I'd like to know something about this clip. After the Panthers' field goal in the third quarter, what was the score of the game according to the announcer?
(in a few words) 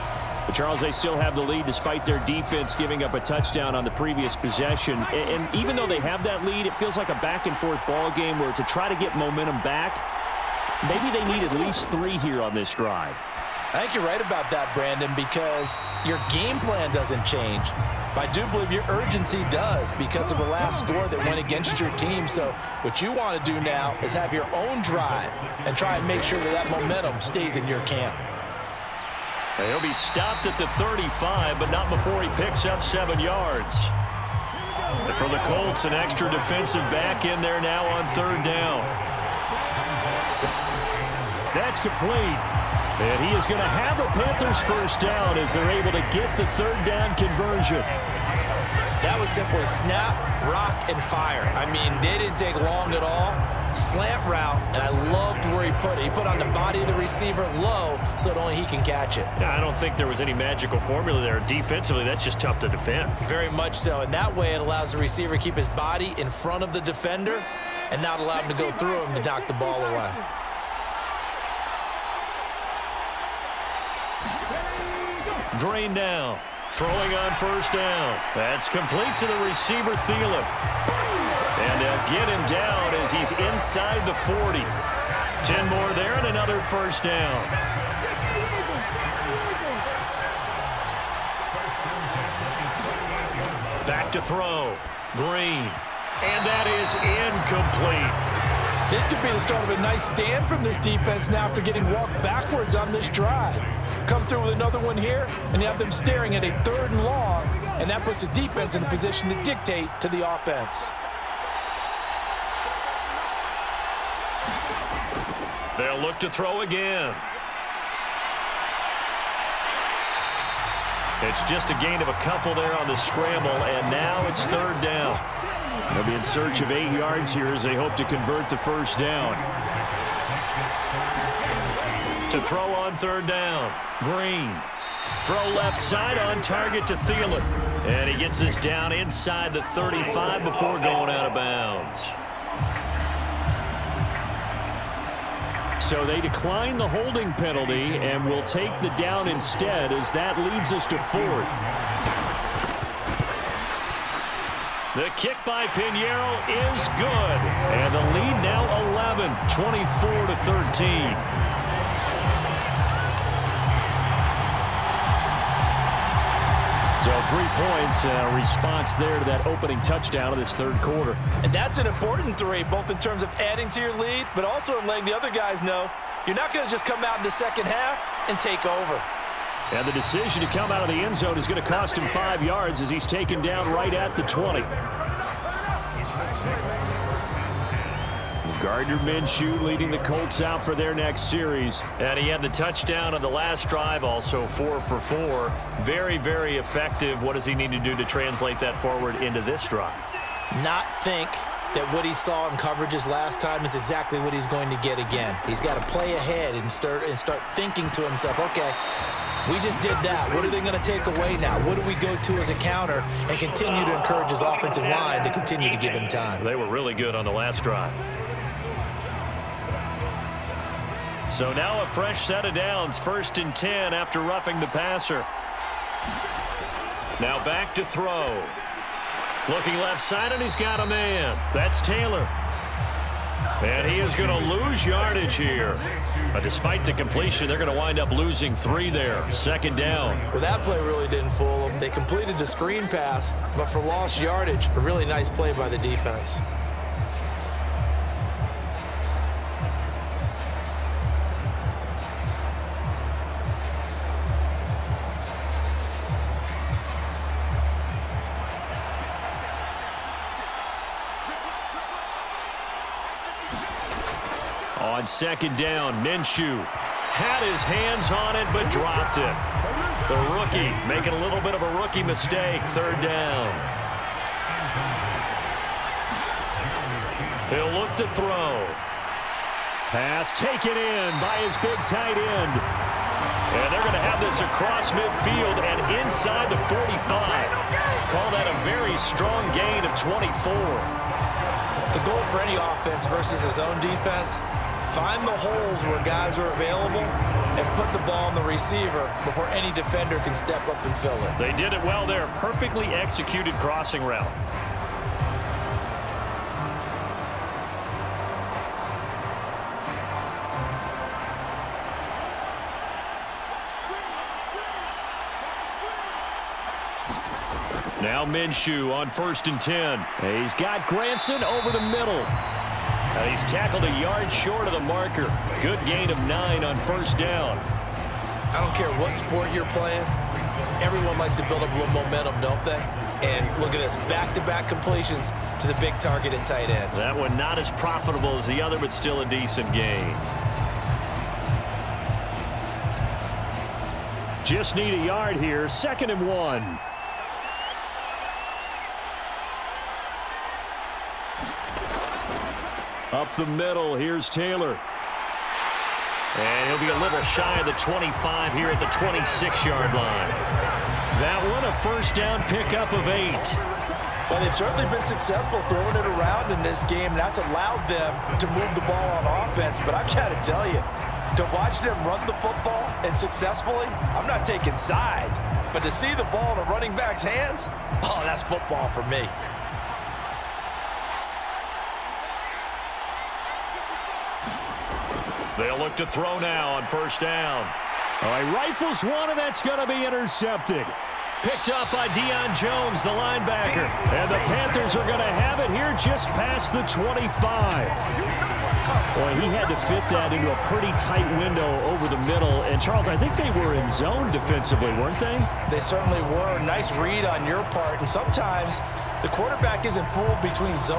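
24 to 13.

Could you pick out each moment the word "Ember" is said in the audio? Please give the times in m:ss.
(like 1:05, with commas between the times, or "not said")
not said.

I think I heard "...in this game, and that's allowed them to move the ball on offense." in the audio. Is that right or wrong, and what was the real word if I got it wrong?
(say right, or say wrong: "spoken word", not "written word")
right.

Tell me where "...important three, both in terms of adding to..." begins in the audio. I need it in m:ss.
2:51.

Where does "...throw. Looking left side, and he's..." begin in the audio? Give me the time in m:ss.
3:47.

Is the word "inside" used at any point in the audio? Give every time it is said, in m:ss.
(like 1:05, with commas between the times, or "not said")
1:23, 2:18, 4:45.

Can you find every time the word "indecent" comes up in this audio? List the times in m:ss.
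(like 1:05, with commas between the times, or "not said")
not said.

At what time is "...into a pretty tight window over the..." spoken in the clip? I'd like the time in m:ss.
6:40.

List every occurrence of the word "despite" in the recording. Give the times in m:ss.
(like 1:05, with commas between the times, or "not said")
0:01, 3:56.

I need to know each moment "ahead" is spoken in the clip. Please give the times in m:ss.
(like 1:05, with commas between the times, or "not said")
3:26.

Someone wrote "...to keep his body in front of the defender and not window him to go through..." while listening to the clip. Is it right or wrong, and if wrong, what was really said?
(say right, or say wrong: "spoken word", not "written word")
wrong: "allow", not "window".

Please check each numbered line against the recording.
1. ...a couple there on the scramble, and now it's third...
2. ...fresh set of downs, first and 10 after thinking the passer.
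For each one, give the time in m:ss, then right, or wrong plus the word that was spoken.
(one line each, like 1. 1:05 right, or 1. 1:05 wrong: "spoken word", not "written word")
1. 2:02 right
2. 3:41 wrong: "roughing", not "thinking".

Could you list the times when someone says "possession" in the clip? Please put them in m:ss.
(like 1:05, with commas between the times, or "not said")
0:04.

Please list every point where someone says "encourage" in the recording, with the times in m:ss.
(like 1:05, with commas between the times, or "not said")
3:33.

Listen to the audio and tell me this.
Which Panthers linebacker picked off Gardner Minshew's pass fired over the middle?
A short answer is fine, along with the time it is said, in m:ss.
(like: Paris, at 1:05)
Deion Jones, at 6:32.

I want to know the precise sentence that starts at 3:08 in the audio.
Gardner Minshew leading the Colts out for their next series.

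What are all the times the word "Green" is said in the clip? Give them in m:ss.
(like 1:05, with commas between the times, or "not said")
1:15, 1:35, 2:13.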